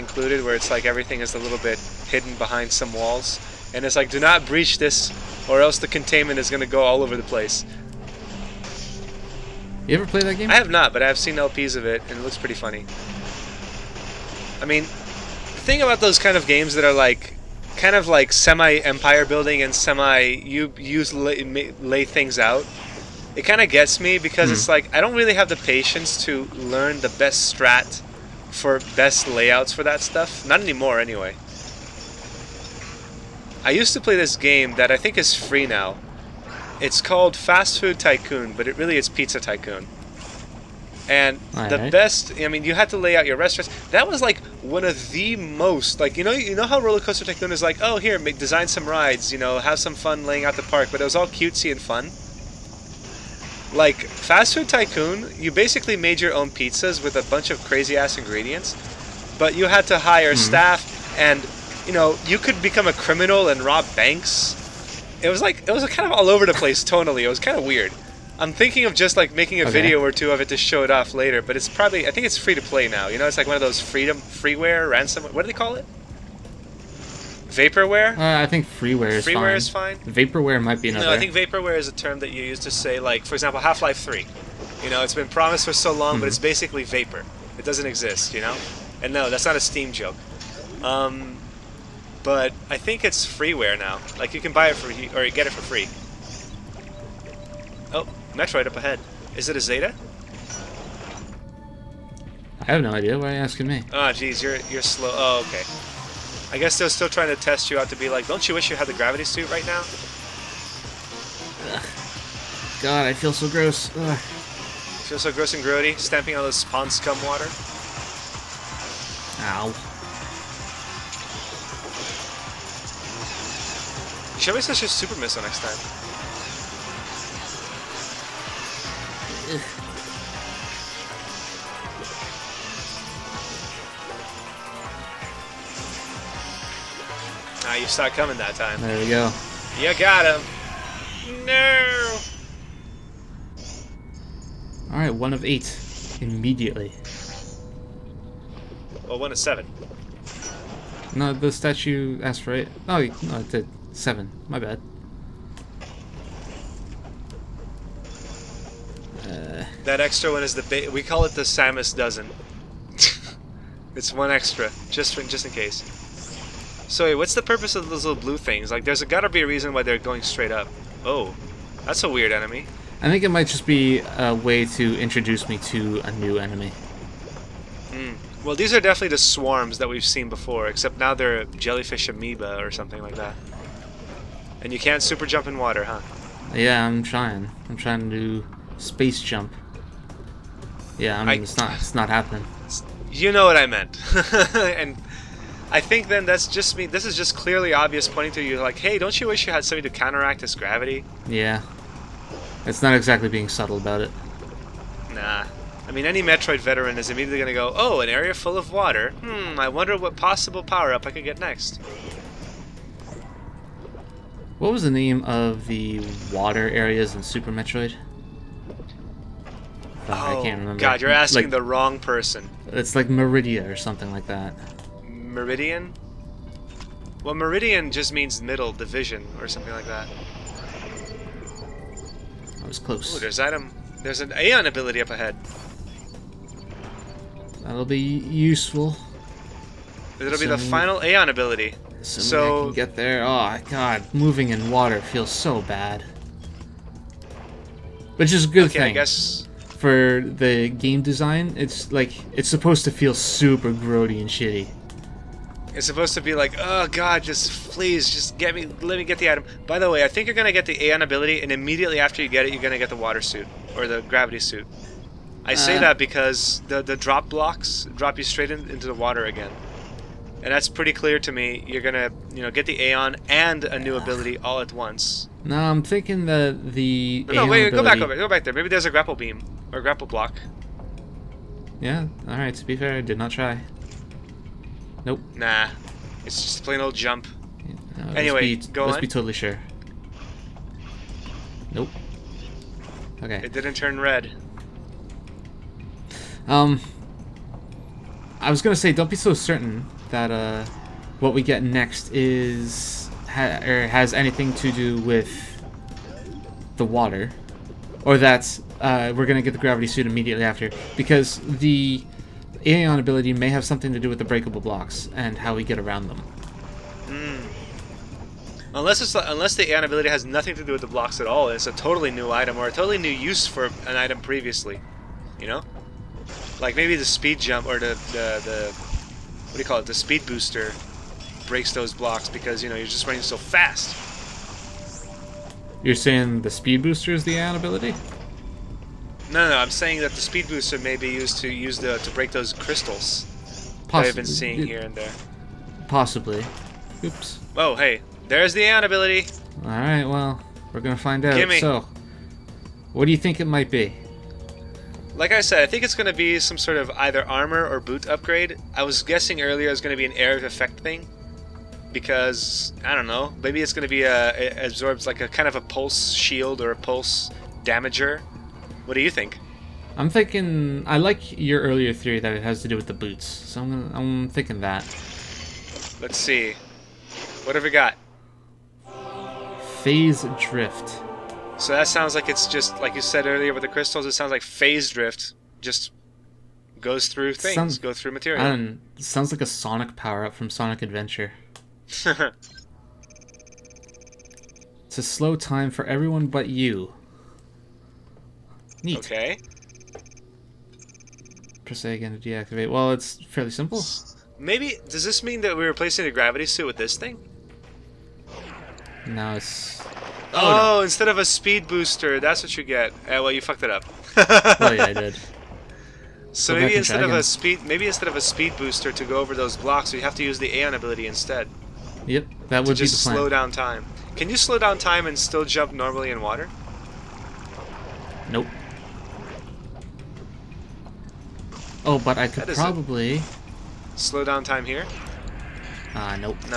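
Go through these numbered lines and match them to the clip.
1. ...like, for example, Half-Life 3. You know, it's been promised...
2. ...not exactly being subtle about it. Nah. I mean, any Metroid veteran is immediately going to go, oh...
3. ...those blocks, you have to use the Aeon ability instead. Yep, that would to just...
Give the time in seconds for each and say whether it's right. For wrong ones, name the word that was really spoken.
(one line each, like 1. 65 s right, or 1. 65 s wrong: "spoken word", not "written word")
1. 82 s right
2. 202 s right
3. 419 s right.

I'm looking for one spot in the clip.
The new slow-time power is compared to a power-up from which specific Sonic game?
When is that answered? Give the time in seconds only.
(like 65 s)
390 s.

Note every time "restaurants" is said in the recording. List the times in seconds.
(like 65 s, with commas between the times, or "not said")
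43 s.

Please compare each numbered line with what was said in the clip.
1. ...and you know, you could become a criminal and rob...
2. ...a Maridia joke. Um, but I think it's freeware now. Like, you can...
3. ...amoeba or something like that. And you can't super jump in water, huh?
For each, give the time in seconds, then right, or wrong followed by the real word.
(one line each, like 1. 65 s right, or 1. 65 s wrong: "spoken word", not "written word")
1. 61 s right
2. 89 s wrong: "Steam", not "Maridia"
3. 182 s right.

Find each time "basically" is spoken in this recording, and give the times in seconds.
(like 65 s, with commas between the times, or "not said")
55 s, 86 s.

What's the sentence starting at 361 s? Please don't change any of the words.
Because, I don't know, maybe it's going to be a, absorbs like a kind of a pulse shield or a pulse damager.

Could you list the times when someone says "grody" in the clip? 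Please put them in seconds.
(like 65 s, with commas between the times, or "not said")
115 s, 253 s.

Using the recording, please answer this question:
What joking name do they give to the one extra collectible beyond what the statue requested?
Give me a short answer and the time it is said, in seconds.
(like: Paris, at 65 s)
Samus dozen, at 161 s.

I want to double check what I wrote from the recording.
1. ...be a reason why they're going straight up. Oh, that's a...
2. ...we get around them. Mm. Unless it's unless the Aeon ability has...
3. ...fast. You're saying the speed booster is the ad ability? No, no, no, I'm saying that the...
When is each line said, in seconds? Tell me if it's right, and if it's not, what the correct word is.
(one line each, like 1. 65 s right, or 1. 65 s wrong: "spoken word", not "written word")
1. 169 s right
2. 315 s right
3. 333 s right.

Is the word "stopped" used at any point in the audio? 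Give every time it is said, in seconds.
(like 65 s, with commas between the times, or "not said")
137 s.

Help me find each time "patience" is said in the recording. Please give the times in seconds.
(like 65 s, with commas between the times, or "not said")
25 s.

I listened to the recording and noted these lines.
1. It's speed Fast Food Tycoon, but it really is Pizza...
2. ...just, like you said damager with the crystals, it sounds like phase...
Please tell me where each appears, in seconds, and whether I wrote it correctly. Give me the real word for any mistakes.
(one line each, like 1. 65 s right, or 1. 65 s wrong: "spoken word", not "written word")
1. 36 s wrong: "called", not "speed"
2. 382 s wrong: "earlier", not "damager".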